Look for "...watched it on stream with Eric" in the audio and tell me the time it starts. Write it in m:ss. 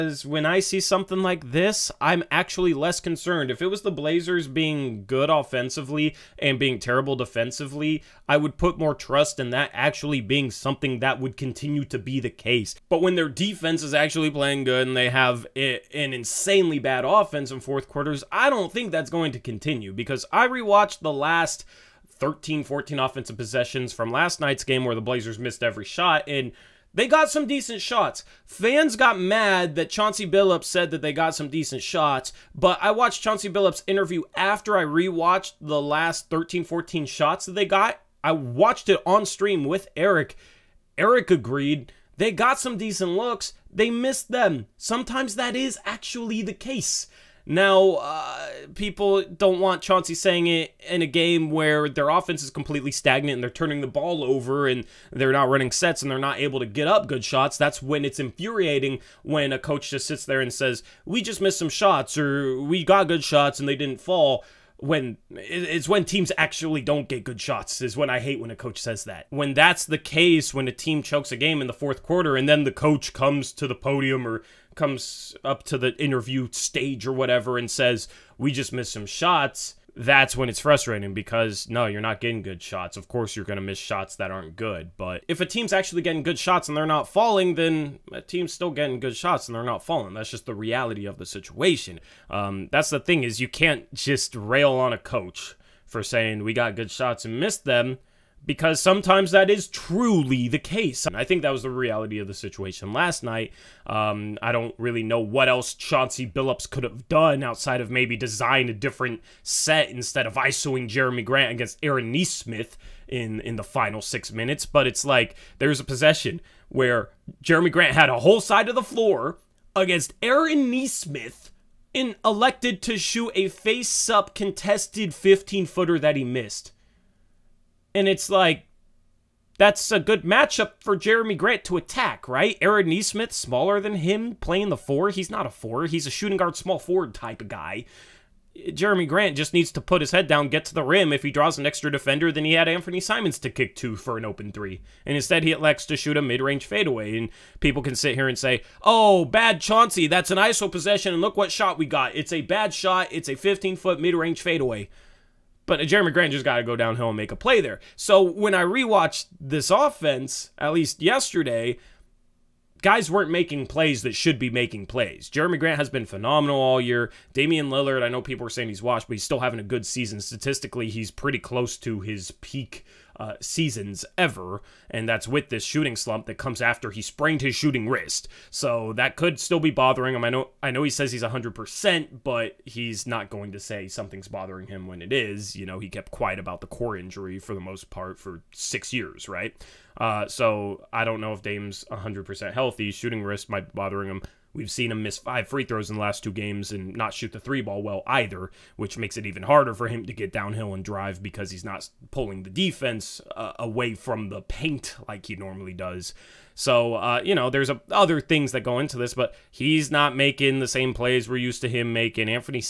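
0:38.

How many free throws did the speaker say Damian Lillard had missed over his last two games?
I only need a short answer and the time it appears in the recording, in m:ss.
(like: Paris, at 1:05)
5, at 3:15.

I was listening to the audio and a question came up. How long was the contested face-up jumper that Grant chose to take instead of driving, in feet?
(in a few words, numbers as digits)
15.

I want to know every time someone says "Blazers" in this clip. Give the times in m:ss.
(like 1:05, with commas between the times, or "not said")
0:03, 0:25.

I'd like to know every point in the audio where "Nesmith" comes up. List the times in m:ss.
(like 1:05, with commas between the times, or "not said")
1:52, 2:00, 2:12.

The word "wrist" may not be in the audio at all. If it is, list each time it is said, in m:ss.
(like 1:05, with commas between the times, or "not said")
2:57, 3:13.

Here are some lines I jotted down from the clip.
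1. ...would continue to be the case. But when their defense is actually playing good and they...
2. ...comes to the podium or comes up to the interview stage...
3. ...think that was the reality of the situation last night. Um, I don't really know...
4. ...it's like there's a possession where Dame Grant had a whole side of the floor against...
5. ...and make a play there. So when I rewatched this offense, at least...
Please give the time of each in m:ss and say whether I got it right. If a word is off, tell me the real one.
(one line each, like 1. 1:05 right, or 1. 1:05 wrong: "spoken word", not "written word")
1. 0:11 right
2. 1:13 right
3. 1:41 right
4. 1:54 wrong: "Jerami", not "Dame"
5. 2:37 right.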